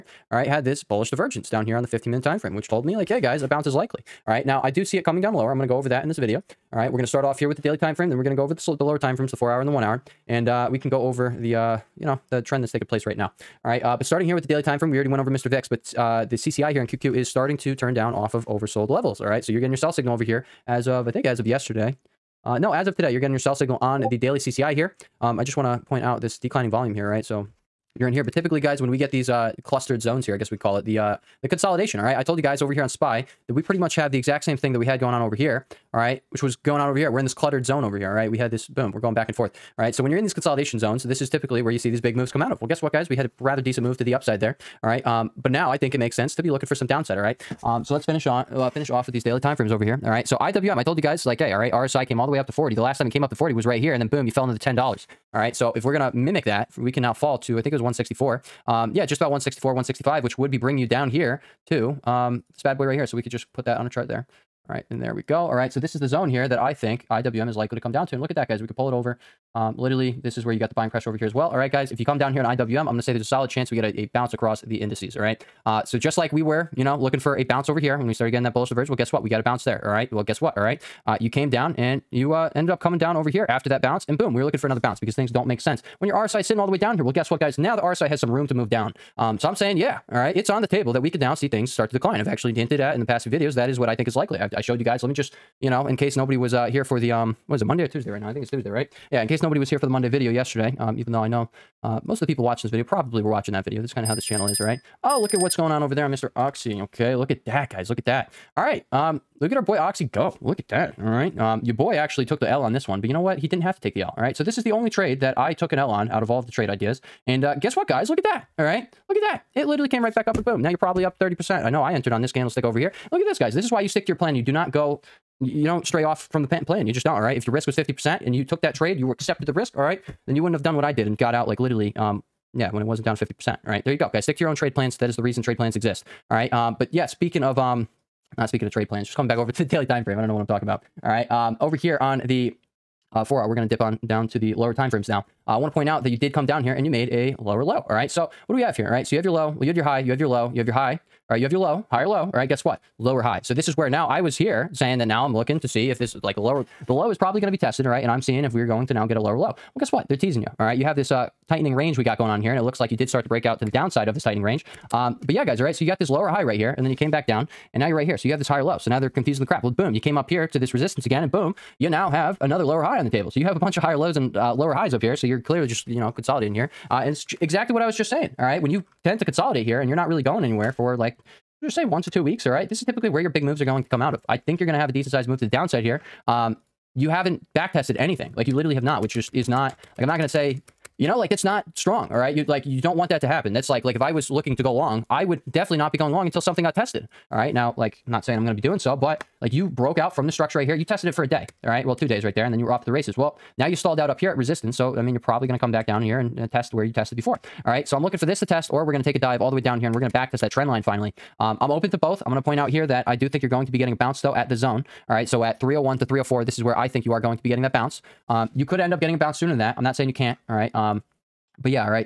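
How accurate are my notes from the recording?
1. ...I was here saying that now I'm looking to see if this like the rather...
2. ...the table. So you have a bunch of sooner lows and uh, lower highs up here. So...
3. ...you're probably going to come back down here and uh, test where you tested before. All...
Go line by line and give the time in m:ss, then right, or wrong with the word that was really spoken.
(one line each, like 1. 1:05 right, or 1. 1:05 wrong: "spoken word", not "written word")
1. 2:34 wrong: "lower", not "rather"
2. 2:53 wrong: "higher", not "sooner"
3. 3:25 right.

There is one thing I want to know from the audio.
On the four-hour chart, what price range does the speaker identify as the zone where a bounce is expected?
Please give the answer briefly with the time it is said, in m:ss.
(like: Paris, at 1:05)
301 to 304, at 3:35.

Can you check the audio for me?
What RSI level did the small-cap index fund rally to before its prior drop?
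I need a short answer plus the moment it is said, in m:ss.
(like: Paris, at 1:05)
40, at 0:51.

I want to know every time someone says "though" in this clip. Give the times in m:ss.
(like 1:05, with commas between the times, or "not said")
1:41, 3:34.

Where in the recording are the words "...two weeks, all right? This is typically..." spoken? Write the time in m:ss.
3:02.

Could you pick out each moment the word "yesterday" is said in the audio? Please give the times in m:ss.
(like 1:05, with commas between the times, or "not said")
0:21, 1:40.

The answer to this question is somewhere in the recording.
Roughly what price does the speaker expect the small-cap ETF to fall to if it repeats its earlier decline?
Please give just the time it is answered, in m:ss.
0:57.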